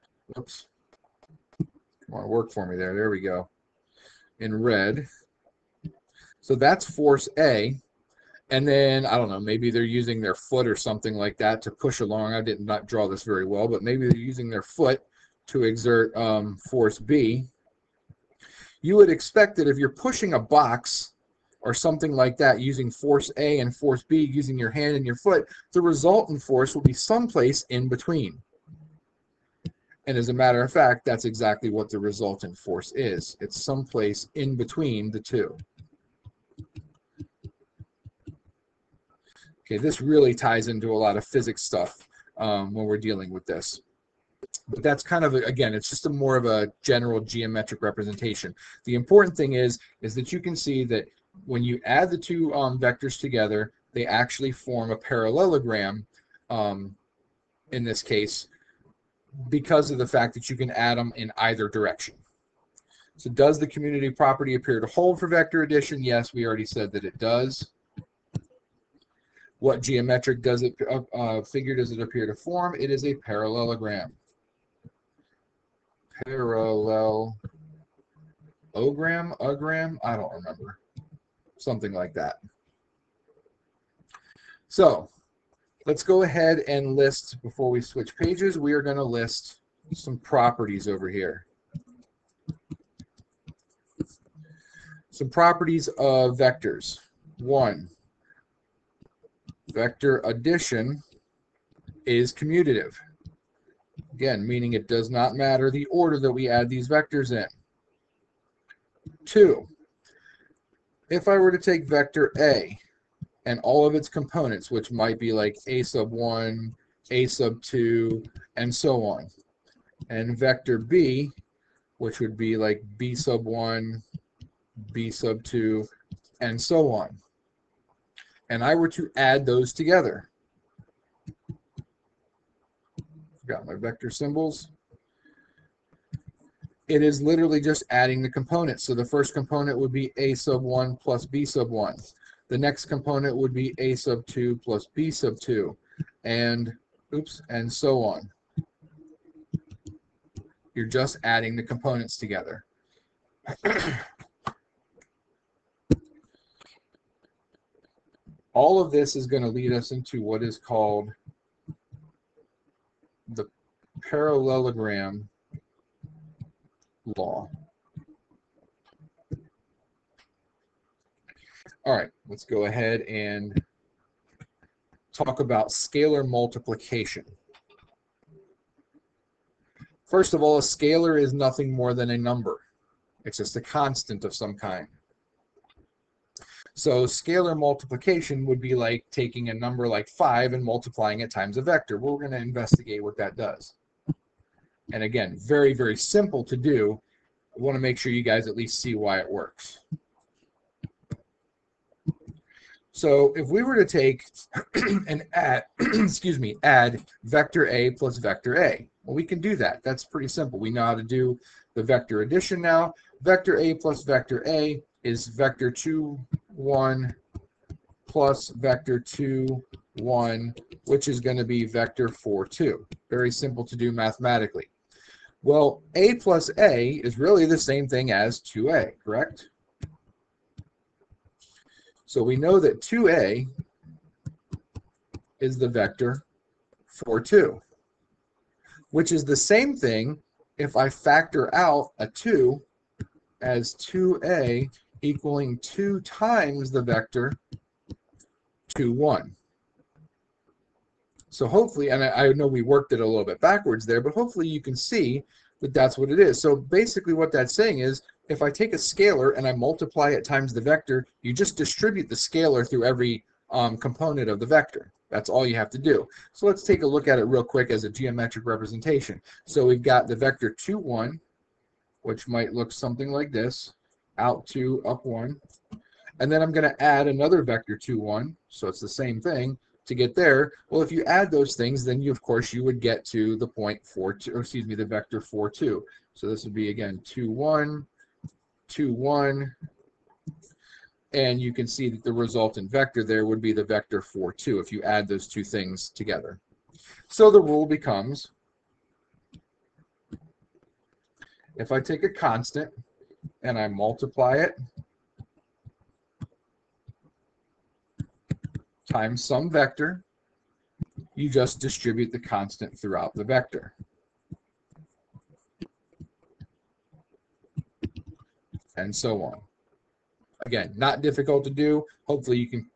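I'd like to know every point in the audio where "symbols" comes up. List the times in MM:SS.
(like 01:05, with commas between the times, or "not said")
02:14.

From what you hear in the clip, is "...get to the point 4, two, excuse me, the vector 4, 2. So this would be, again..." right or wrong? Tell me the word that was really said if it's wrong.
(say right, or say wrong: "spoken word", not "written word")
right.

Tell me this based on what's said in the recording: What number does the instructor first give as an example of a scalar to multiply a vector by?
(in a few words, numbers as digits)
5.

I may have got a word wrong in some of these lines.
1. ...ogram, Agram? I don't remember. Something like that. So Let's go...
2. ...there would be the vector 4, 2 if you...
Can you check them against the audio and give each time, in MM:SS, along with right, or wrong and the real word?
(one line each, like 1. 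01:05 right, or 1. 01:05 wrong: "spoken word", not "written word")
1. 01:18 right
2. 04:53 right.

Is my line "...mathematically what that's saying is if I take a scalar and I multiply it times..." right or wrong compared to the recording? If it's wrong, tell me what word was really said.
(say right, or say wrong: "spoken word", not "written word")
wrong: "basically", not "mathematically".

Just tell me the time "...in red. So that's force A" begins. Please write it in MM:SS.
00:04.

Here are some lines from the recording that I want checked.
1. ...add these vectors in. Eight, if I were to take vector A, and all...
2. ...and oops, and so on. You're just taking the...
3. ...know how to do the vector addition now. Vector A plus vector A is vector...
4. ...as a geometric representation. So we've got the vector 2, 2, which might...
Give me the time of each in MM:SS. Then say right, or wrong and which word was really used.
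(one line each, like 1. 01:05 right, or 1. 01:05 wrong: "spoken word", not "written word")
1. 01:46 wrong: "Two", not "Eight"
2. 02:26 wrong: "adding", not "taking"
3. 03:30 right
4. 04:27 wrong: "1", not "2".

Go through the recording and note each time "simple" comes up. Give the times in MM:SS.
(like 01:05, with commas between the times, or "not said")
03:15, 03:30, 03:43.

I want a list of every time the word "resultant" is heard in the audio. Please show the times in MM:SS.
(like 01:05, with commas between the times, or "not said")
00:25, 00:31, 04:52.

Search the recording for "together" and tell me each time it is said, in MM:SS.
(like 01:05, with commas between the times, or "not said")
00:53, 02:09, 02:32, 04:55.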